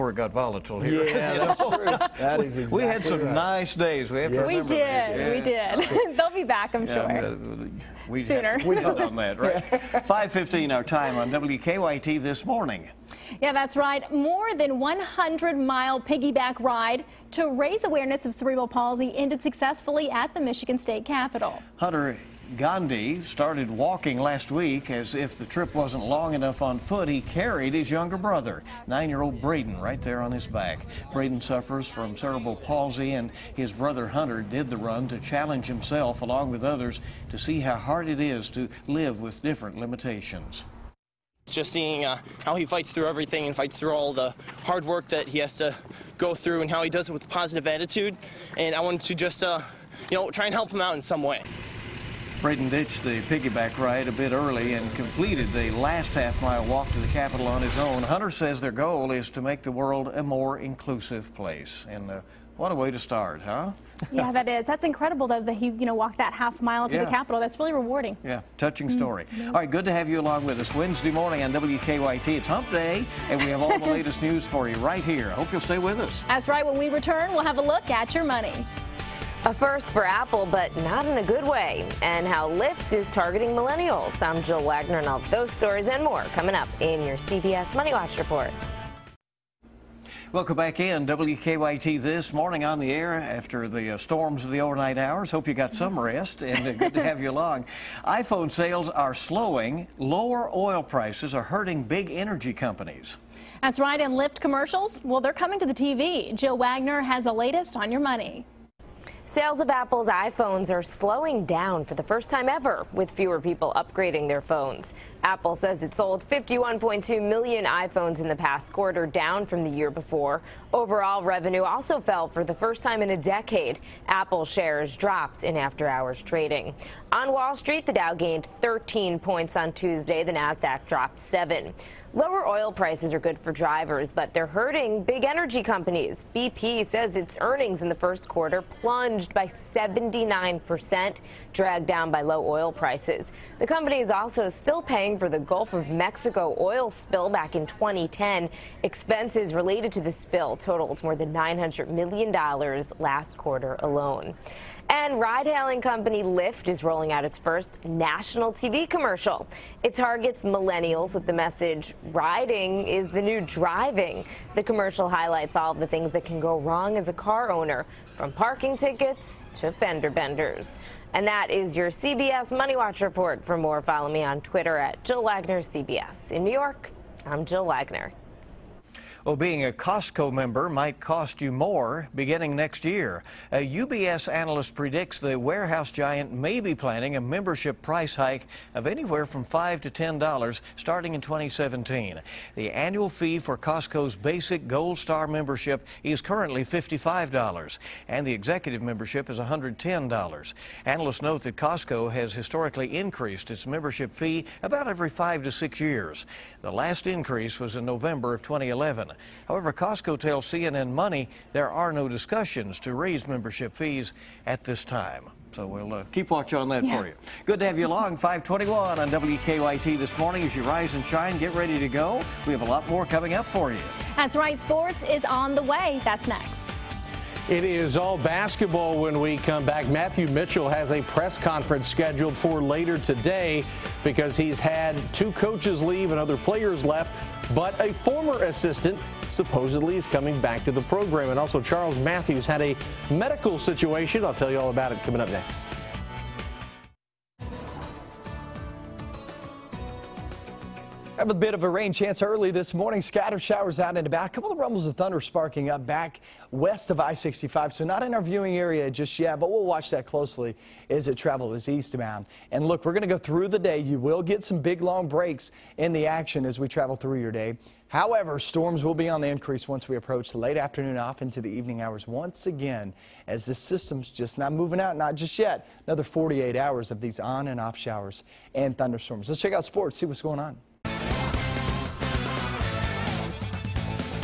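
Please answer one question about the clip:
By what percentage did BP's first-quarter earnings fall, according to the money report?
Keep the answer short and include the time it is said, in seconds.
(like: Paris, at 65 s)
79%, at 139 s.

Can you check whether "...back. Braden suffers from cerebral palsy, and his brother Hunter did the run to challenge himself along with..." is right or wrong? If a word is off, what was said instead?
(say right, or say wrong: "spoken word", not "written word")
right.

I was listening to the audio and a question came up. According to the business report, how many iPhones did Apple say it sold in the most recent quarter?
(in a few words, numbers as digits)
51.2 million.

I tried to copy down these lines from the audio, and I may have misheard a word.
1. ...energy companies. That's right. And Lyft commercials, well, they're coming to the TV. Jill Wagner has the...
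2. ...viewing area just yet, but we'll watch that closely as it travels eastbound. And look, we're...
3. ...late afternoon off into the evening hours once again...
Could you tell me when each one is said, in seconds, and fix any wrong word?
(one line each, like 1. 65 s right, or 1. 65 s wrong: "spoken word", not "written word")
1. 102 s right
2. 258 s right
3. 270 s right.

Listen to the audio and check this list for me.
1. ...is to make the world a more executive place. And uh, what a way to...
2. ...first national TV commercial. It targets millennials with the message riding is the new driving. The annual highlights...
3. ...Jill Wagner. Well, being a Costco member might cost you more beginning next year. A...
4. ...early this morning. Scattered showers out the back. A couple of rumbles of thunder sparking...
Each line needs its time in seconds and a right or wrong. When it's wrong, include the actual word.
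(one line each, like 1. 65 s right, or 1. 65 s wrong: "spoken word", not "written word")
1. 59 s wrong: "inclusive", not "executive"
2. 157 s wrong: "commercial", not "annual"
3. 177 s right
4. 252 s right.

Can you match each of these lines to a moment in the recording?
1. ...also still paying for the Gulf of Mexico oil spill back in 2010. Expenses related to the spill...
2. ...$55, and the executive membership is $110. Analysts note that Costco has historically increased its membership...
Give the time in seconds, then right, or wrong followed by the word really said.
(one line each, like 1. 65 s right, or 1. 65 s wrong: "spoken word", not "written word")
1. 144 s right
2. 196 s right.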